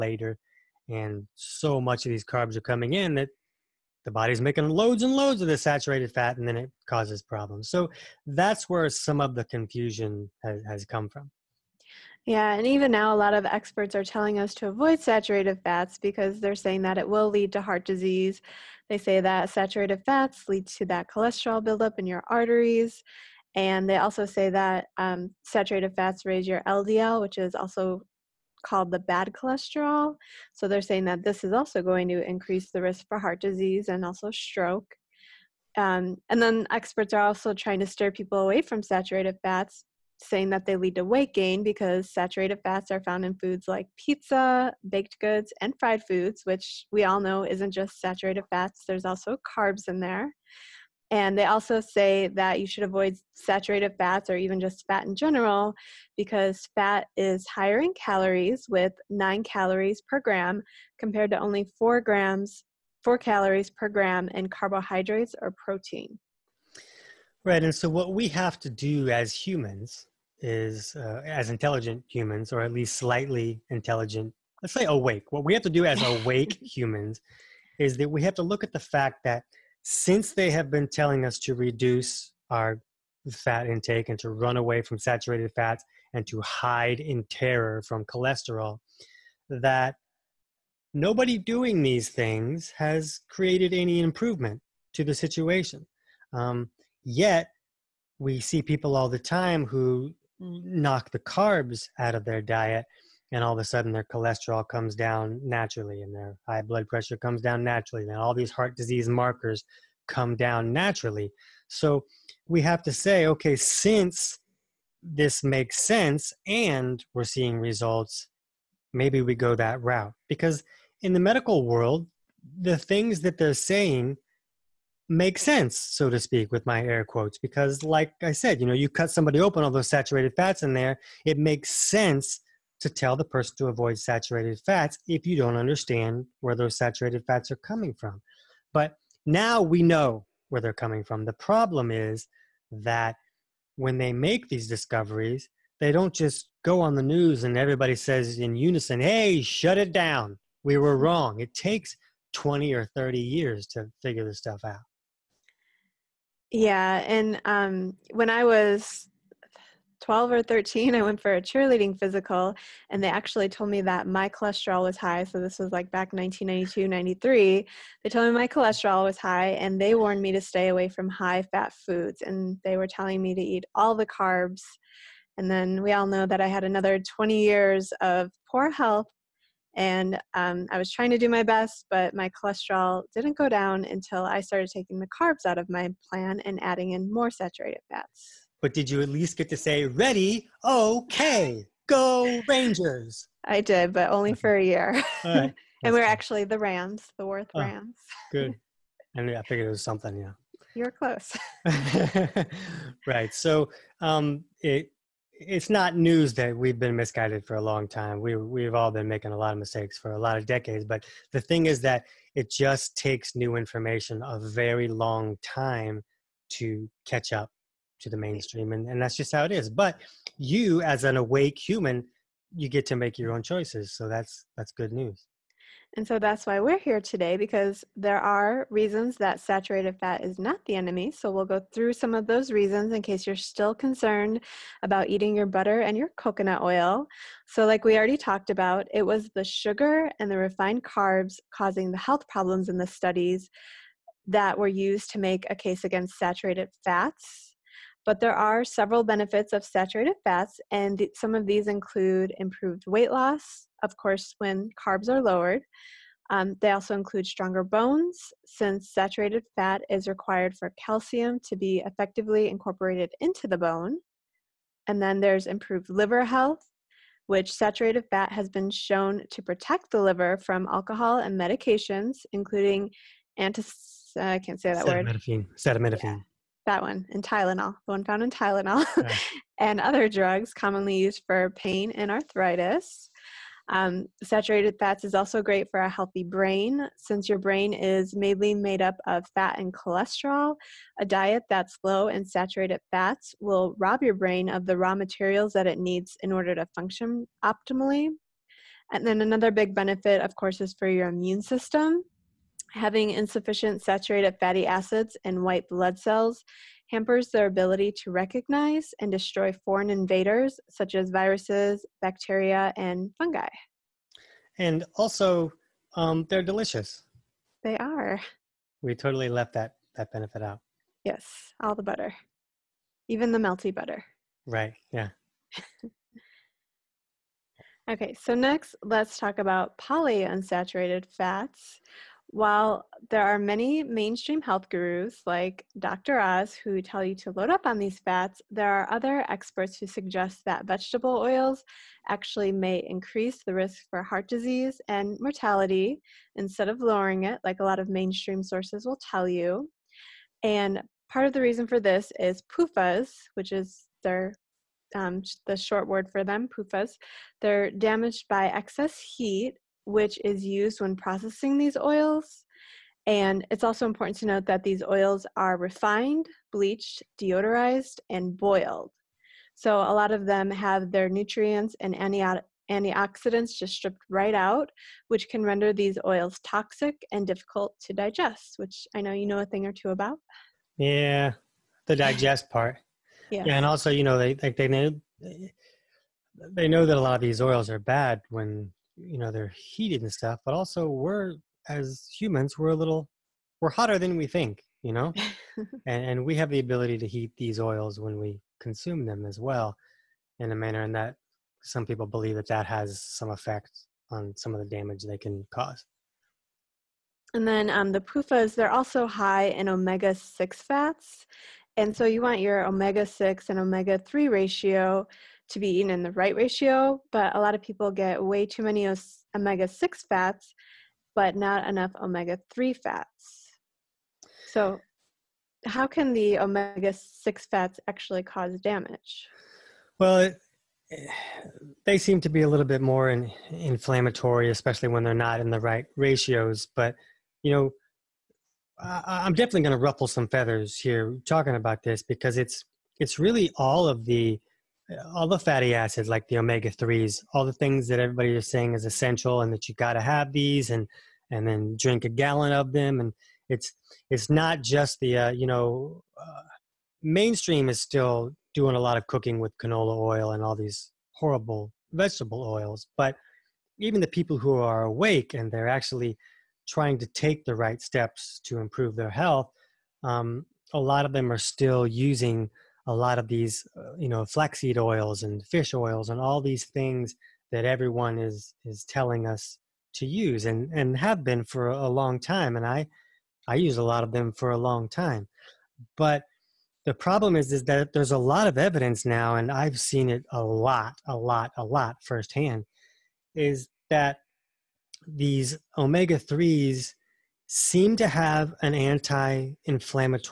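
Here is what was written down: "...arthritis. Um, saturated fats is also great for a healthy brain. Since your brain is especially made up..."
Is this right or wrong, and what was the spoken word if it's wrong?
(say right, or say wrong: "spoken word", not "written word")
wrong: "mainly", not "especially".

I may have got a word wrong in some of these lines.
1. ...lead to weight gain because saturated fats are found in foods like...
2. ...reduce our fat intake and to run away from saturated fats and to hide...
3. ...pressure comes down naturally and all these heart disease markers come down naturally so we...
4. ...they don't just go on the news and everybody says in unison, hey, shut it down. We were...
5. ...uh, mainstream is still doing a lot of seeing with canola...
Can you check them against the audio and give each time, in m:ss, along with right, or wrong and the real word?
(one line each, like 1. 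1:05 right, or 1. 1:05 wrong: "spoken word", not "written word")
1. 0:40 right
2. 1:21 right
3. 1:46 right
4. 2:25 right
5. 7:36 wrong: "cooking", not "seeing".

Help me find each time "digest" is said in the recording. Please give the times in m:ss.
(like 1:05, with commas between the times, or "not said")
6:17, 6:21.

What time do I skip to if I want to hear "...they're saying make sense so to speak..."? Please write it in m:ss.
2:03.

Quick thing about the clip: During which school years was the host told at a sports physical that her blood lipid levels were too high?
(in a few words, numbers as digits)
1992, 93.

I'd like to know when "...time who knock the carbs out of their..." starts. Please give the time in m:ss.
1:39.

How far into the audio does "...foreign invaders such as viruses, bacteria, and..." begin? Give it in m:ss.
5:09.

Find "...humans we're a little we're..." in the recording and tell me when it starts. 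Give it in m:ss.
6:32.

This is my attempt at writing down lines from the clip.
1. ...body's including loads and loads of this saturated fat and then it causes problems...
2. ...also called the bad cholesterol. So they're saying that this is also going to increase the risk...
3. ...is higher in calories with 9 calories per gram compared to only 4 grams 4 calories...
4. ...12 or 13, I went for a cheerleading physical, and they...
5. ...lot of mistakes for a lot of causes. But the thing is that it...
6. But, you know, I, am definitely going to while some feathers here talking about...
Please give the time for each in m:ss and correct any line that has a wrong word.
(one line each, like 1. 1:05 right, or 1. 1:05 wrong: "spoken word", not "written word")
1. 0:04 wrong: "making", not "including"
2. 0:27 right
3. 0:57 right
4. 2:40 right
5. 3:29 wrong: "decades", not "causes"
6. 7:16 wrong: "ruffle", not "while".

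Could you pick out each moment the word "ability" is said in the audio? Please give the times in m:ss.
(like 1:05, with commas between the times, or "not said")
5:07, 6:36.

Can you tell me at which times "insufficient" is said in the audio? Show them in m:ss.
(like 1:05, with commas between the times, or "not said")
5:03.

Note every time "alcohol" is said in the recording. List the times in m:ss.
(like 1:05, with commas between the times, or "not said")
4:30.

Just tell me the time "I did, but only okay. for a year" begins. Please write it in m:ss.
3:13.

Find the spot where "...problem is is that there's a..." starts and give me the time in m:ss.
8:06.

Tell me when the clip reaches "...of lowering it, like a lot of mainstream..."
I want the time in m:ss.
5:46.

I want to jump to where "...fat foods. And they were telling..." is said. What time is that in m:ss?
2:51.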